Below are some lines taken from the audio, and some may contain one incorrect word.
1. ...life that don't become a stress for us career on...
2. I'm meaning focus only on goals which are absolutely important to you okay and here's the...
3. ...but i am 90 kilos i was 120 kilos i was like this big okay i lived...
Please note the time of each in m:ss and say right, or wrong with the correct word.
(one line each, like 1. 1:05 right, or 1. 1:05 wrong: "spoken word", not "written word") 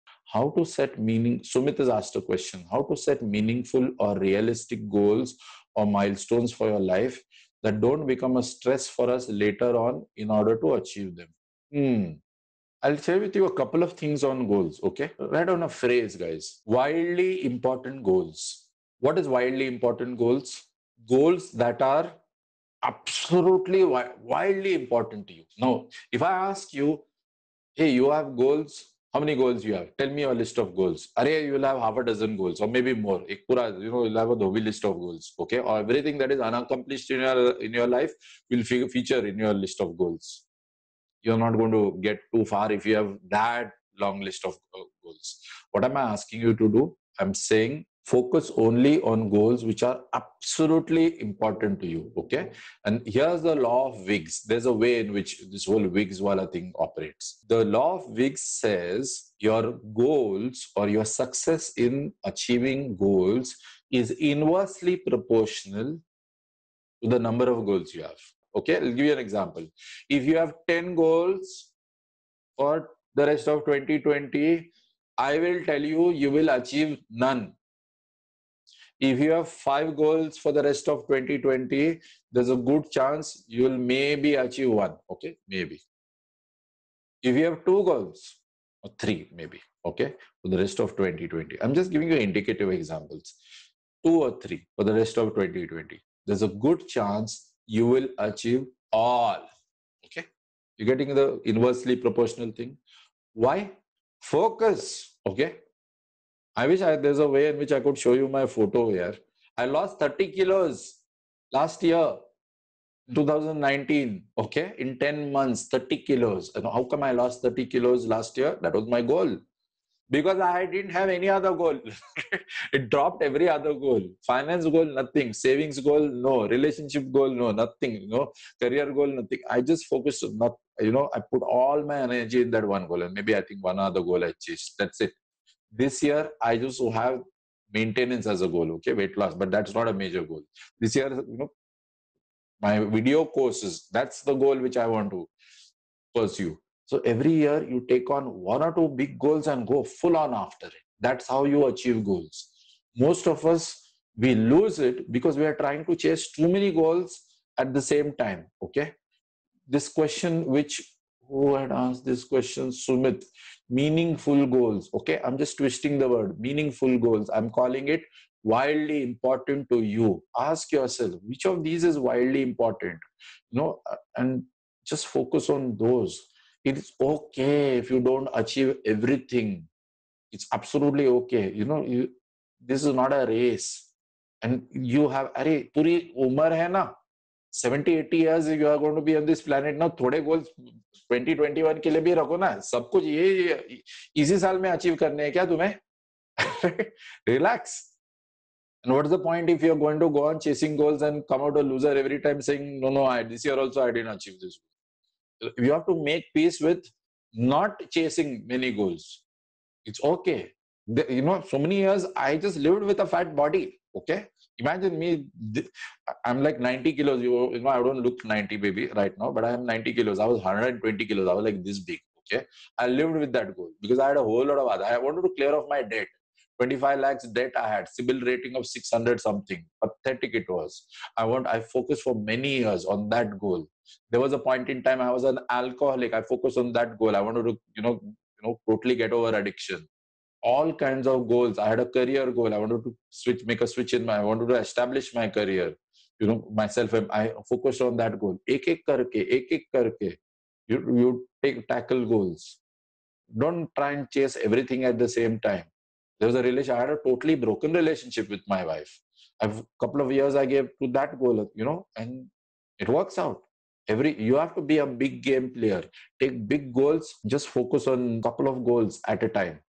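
1. 0:06 wrong: "later", not "career"
2. 0:47 wrong: "saying", not "meaning"
3. 3:39 right.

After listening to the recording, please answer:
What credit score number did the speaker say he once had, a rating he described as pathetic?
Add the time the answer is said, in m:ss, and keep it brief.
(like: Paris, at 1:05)
600, at 3:48.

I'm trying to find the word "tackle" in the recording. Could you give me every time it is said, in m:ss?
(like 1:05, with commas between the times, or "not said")
4:11.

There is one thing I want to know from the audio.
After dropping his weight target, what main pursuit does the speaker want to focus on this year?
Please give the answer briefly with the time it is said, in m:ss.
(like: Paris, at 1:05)
video courses, at 2:22.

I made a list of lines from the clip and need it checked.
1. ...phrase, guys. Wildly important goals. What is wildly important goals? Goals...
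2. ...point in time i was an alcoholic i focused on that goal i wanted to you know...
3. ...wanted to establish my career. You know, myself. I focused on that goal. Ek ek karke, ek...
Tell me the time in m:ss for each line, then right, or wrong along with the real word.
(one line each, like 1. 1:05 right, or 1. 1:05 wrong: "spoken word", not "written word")
1. 0:15 right
2. 3:54 right
3. 4:04 right.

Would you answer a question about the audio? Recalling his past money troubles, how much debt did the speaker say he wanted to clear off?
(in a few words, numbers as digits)
25 lakhs.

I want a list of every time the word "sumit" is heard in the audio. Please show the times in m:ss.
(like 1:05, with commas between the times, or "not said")
0:01, 2:42.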